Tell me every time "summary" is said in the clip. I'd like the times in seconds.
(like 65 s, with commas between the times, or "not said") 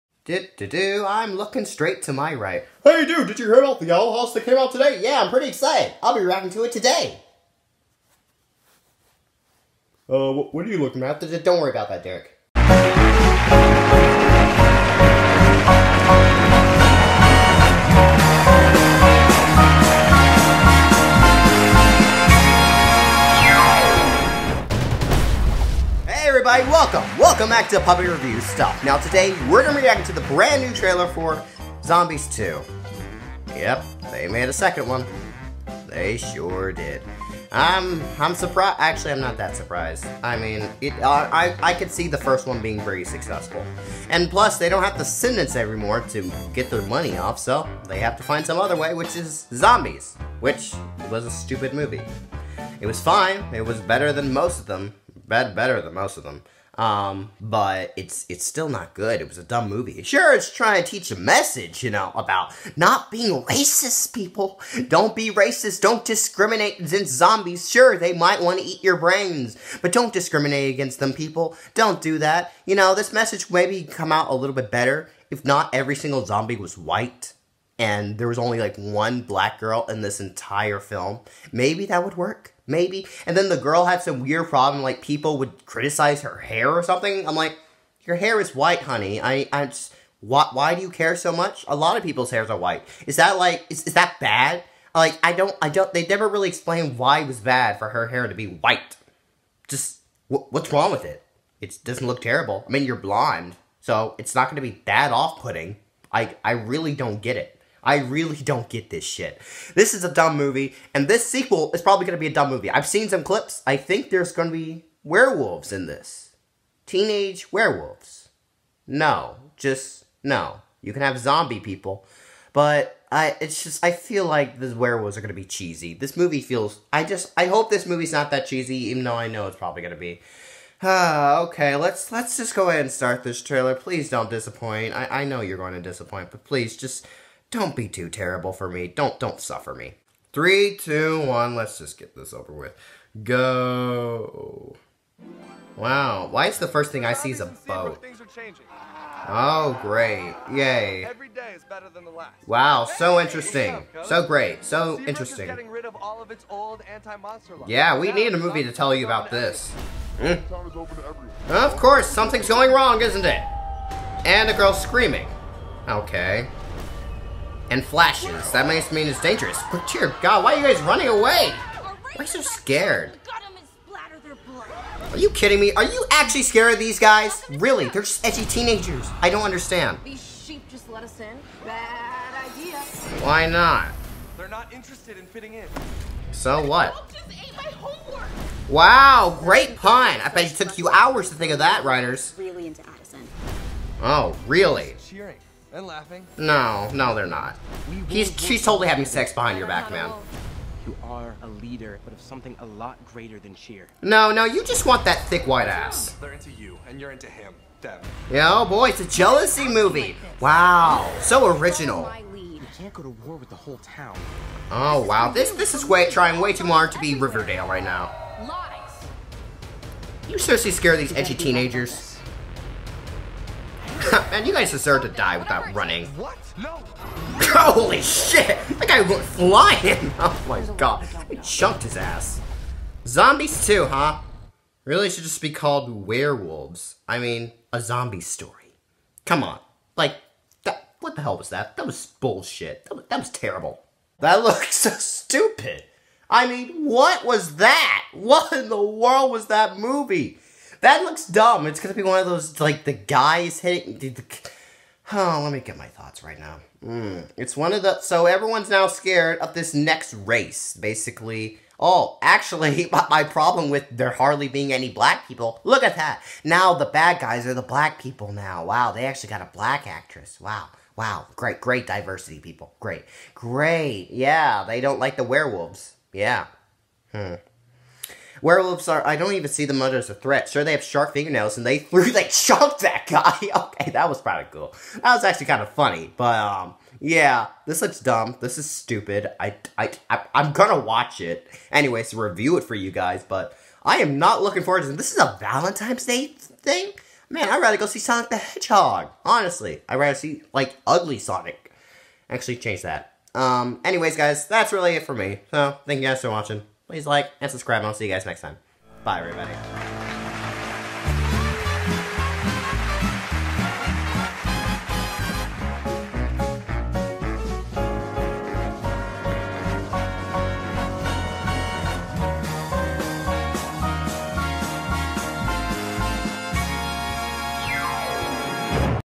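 not said.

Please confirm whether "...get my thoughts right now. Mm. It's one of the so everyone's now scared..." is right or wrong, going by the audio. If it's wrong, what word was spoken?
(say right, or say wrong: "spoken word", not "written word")
right.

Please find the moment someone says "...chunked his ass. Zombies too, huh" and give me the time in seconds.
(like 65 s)
231 s.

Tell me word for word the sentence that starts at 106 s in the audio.
I, I really don't get it.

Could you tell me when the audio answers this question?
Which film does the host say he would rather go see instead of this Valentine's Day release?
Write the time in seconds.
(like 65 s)
297 s.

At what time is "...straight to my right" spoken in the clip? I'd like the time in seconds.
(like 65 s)
1 s.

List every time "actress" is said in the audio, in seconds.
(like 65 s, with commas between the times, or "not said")
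269 s.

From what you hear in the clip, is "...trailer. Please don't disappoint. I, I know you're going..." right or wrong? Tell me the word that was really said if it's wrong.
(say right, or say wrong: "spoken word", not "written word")
right.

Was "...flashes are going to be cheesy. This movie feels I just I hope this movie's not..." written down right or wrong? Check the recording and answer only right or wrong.
wrong.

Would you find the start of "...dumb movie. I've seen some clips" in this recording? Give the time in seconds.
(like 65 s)
112 s.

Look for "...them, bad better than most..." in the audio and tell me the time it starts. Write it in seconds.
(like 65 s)
54 s.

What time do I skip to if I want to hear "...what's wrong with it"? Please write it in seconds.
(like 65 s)
100 s.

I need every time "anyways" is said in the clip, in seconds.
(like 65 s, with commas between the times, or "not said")
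291 s, 303 s.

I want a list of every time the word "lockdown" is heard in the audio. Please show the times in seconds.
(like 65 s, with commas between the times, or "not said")
not said.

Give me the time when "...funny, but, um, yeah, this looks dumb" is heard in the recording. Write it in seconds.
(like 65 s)
285 s.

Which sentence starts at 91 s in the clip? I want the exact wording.
A lot of people's hairs are white.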